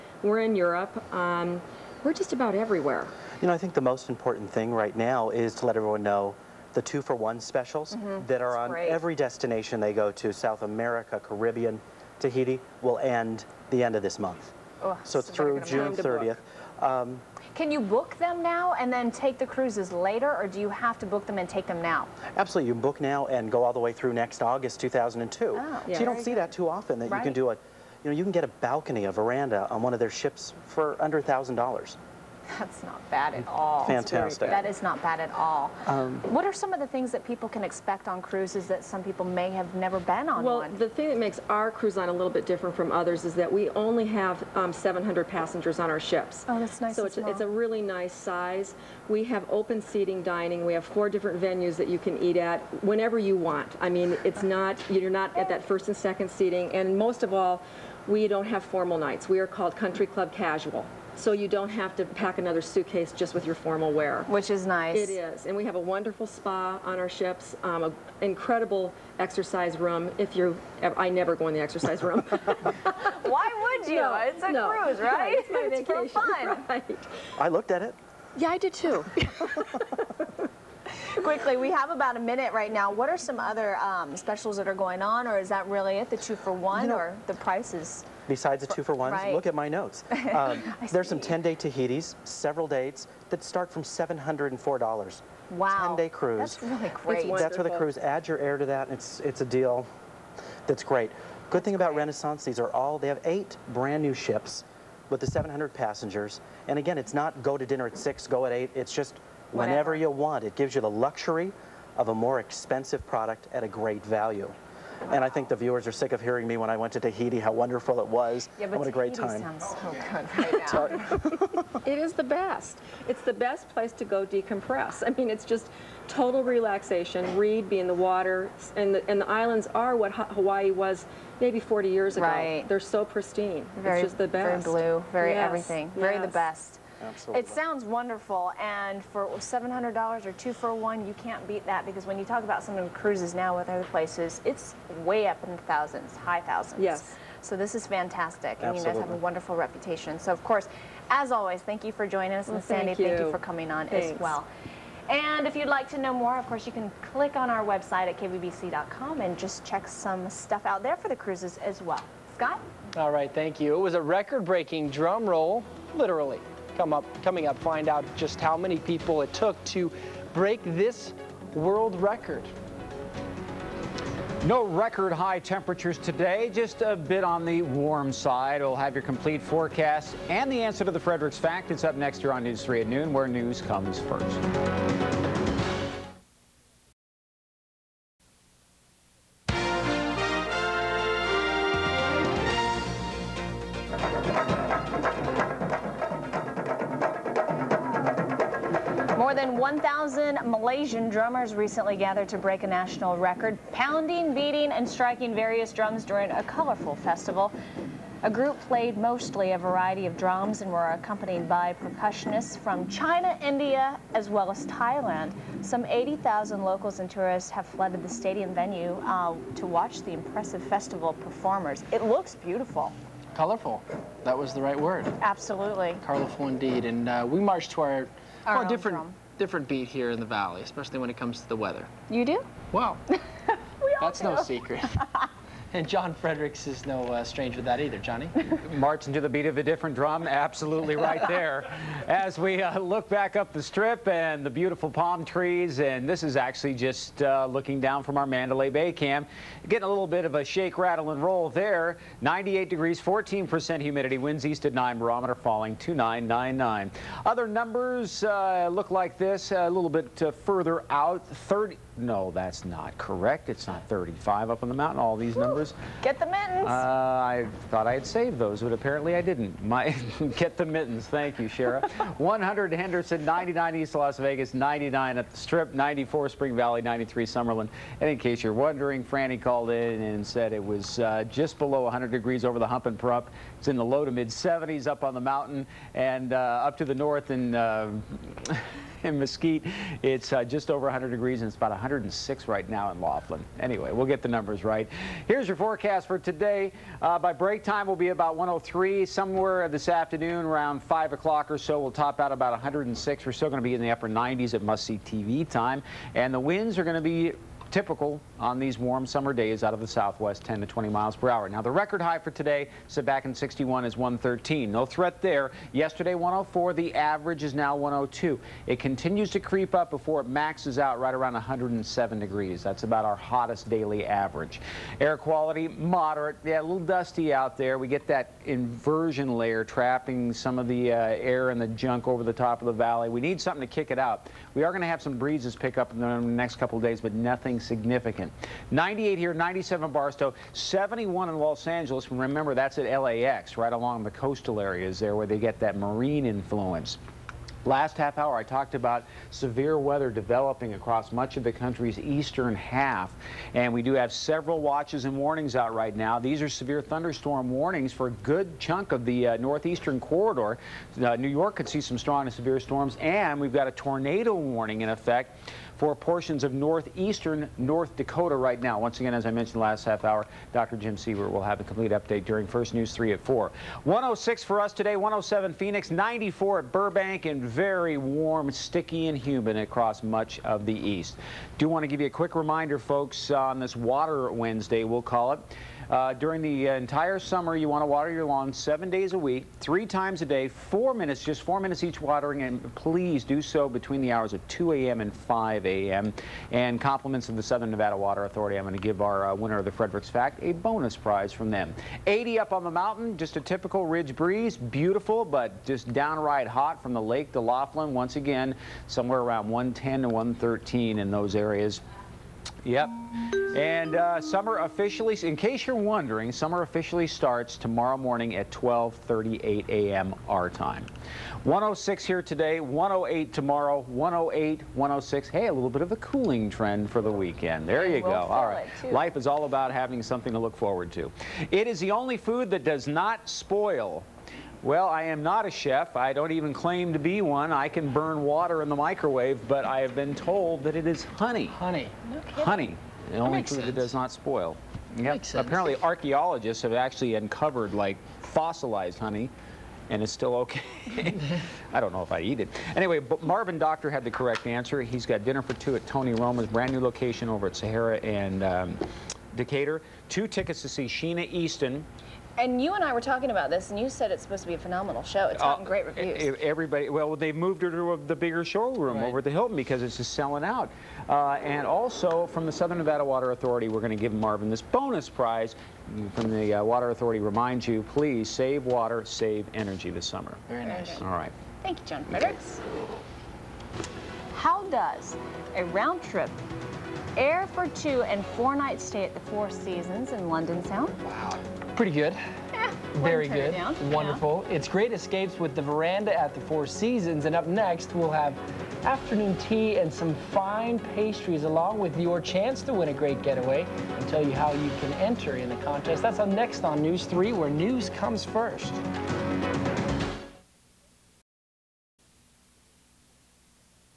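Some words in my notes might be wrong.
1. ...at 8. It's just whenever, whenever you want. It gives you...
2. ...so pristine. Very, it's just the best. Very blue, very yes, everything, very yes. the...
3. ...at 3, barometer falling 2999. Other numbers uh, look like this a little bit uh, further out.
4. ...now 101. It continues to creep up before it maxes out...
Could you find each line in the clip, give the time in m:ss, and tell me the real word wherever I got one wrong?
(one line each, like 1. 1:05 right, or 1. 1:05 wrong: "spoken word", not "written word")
1. 1:48 right
2. 2:12 right
3. 4:14 wrong: "9", not "3"
4. 5:17 wrong: "102", not "101".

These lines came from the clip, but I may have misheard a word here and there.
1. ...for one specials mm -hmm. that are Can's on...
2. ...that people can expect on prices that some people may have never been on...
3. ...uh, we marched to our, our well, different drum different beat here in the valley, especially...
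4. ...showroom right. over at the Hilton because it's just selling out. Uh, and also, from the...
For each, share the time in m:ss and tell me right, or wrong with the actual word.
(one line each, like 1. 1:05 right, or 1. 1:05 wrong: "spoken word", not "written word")
1. 0:07 wrong: "That", not "Can"
2. 0:37 wrong: "cruises", not "prices"
3. 3:47 right
4. 7:48 right.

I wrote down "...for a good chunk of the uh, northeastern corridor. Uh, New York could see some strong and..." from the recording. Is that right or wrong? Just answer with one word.
right.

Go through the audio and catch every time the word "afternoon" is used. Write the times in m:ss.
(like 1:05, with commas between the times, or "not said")
4:59, 8:18.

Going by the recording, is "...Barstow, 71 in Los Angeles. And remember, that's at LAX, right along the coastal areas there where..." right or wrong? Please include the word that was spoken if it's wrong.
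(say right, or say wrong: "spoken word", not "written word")
right.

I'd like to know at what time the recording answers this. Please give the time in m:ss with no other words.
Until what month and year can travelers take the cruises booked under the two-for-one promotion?
0:24.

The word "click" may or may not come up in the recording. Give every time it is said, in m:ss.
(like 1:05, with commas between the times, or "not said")
2:37.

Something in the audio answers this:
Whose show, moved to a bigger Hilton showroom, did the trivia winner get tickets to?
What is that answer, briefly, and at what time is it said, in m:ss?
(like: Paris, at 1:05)
Sheena Easton, at 7:40.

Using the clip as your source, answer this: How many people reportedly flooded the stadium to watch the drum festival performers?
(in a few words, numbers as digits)
80,000.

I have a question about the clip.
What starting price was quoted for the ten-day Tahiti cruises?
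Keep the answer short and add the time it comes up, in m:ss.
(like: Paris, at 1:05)
$704, at 1:33.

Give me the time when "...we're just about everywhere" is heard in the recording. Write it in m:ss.
0:02.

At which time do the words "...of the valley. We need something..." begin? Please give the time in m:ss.
5:32.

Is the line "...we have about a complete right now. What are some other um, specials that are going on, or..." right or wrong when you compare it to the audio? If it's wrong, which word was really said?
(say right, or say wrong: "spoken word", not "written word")
wrong: "minute", not "complete".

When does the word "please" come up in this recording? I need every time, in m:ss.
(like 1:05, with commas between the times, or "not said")
6:32, 7:57.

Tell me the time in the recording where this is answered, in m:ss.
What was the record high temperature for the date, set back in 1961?
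5:13.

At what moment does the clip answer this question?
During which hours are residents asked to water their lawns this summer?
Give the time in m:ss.
6:34.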